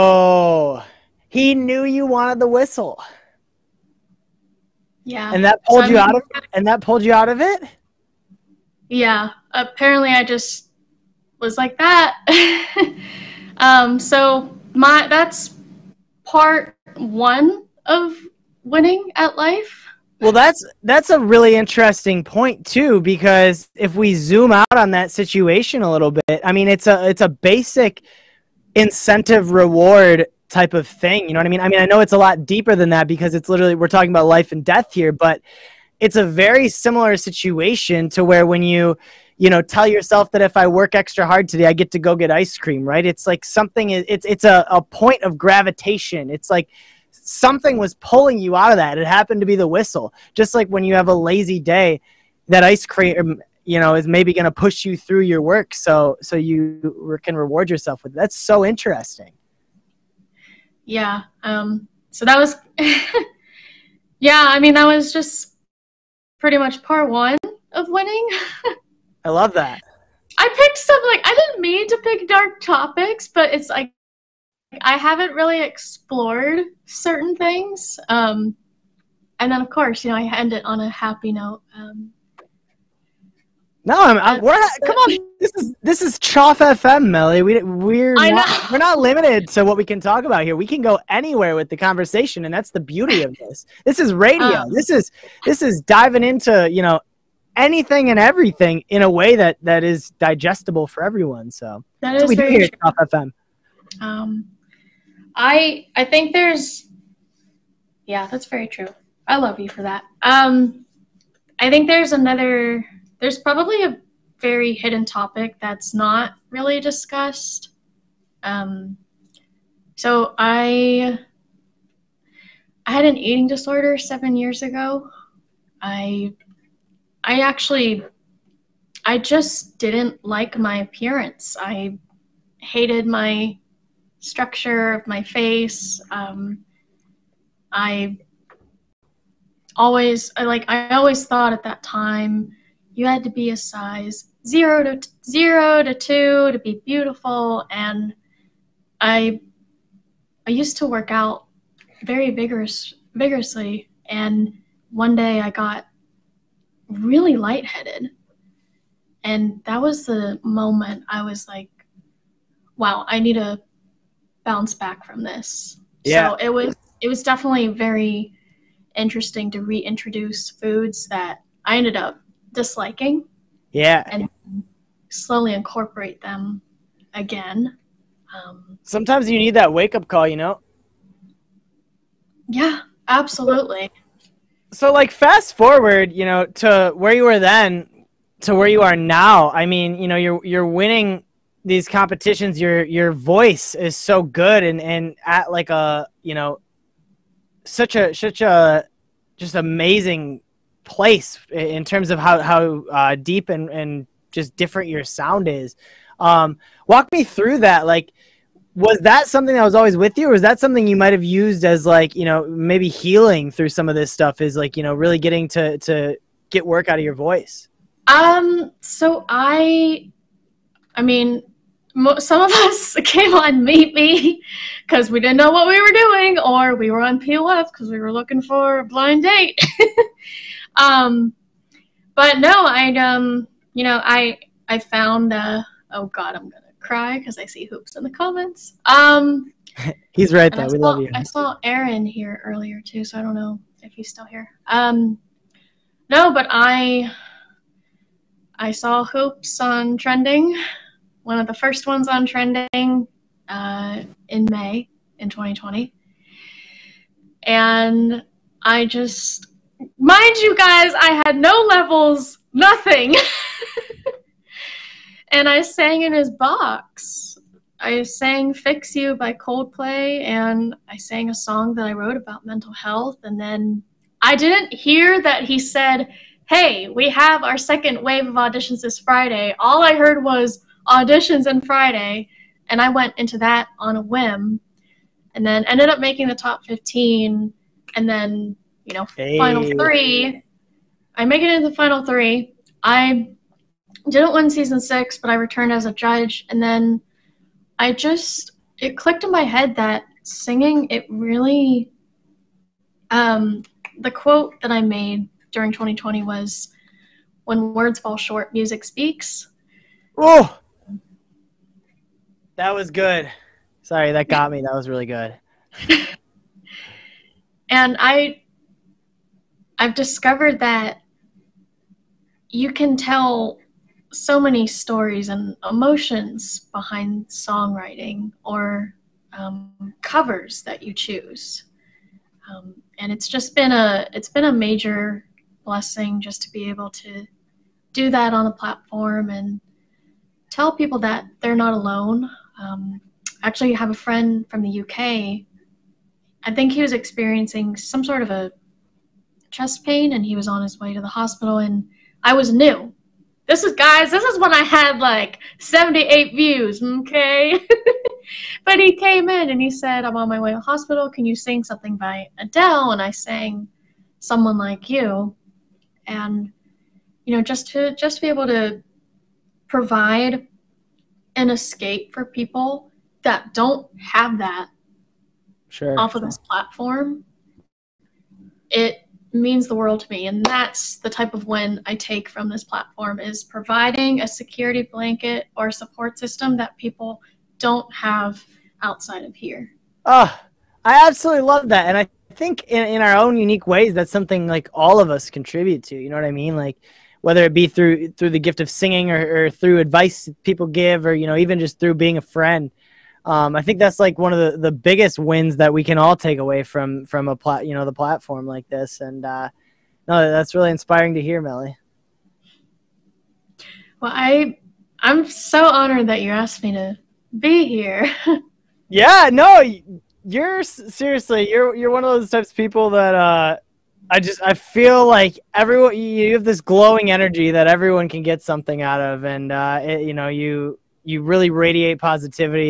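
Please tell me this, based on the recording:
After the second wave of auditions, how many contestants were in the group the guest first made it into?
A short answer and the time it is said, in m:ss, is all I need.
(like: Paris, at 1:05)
Top 15, at 4:46.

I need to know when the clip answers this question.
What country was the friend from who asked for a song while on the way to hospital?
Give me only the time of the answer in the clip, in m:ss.
5:44.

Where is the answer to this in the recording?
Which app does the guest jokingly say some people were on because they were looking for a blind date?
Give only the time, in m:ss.
3:47.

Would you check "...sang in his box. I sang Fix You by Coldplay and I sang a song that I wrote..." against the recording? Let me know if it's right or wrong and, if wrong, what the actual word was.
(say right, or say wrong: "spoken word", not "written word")
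right.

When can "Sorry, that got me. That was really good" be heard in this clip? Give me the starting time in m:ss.
5:13.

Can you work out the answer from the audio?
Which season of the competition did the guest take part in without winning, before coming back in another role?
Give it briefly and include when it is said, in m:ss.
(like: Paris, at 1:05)
Season 6, at 4:54.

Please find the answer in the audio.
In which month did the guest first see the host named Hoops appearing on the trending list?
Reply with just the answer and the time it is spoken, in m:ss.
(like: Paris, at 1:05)
May, at 4:14.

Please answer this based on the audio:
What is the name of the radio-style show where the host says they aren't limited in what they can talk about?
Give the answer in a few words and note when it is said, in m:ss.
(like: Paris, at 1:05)
Choff FM, at 1:26.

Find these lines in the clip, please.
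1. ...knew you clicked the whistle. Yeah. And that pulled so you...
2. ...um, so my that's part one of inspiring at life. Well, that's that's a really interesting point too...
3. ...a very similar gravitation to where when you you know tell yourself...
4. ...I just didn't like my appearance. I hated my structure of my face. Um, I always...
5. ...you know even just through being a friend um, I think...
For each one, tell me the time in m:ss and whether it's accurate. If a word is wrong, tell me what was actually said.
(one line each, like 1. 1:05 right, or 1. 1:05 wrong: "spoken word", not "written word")
1. 0:01 wrong: "wanted", not "clicked"
2. 0:13 wrong: "winning", not "inspiring"
3. 0:36 wrong: "situation", not "gravitation"
4. 2:09 right
5. 6:41 right.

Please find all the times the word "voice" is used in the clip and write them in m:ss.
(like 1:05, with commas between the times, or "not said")
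3:13, 3:37.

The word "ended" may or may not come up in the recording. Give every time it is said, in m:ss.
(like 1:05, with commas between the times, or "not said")
2:51, 4:45.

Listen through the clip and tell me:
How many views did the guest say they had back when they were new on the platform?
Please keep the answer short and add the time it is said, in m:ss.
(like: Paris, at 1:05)
78, at 5:55.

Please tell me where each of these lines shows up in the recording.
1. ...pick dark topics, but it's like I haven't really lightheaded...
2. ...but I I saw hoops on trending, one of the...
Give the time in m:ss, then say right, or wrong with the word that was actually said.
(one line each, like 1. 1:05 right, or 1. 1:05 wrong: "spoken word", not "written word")
1. 1:12 wrong: "explored", not "lightheaded"
2. 4:06 right.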